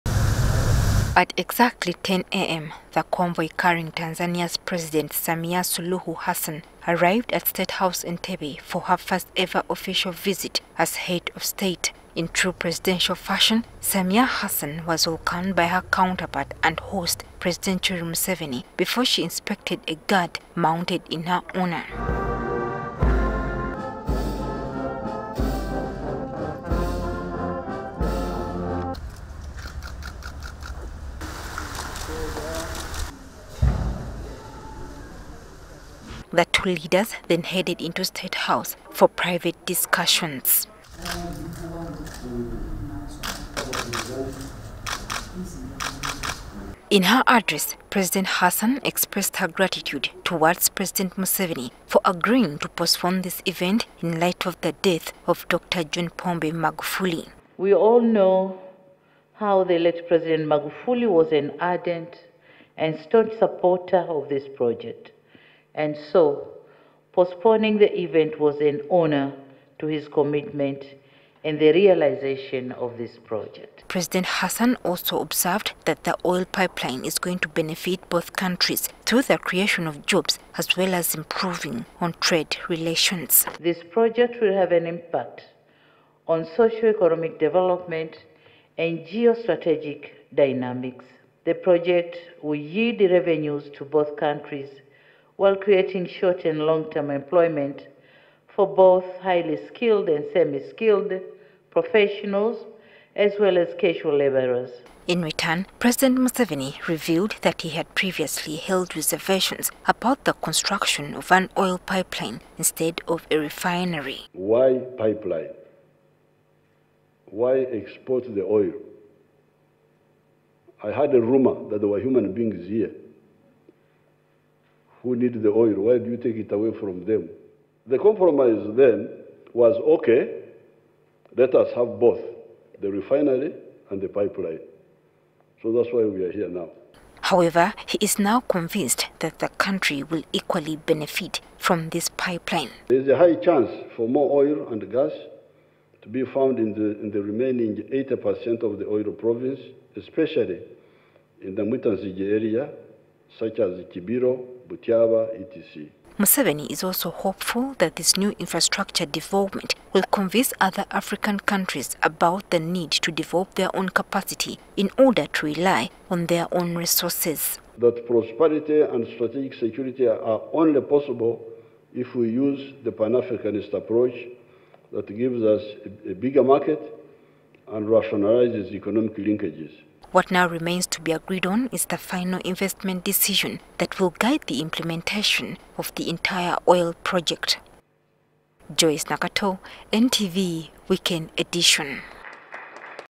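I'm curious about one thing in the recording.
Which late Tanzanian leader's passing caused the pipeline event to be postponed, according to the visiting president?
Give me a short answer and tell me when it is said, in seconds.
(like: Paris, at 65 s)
John Pombe Magufuli, at 55 s.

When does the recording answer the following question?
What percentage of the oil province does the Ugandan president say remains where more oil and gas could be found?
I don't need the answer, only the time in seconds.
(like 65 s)
147 s.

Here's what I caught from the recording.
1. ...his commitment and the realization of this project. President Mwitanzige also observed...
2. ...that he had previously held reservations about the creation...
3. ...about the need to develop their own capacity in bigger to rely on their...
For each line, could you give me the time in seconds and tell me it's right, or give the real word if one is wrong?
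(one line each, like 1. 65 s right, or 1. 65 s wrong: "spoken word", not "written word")
1. 69 s wrong: "Hassan", not "Mwitanzige"
2. 107 s wrong: "construction", not "creation"
3. 162 s wrong: "order", not "bigger".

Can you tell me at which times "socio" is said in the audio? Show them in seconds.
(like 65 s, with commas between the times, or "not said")
86 s.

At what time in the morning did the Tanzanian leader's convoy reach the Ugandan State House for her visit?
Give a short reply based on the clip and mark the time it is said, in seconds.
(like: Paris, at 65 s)
10 a.m., at 2 s.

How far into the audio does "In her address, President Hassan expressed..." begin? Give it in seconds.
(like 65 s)
46 s.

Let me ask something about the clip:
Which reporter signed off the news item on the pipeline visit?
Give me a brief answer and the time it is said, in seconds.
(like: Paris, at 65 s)
Joyce Nakato, at 188 s.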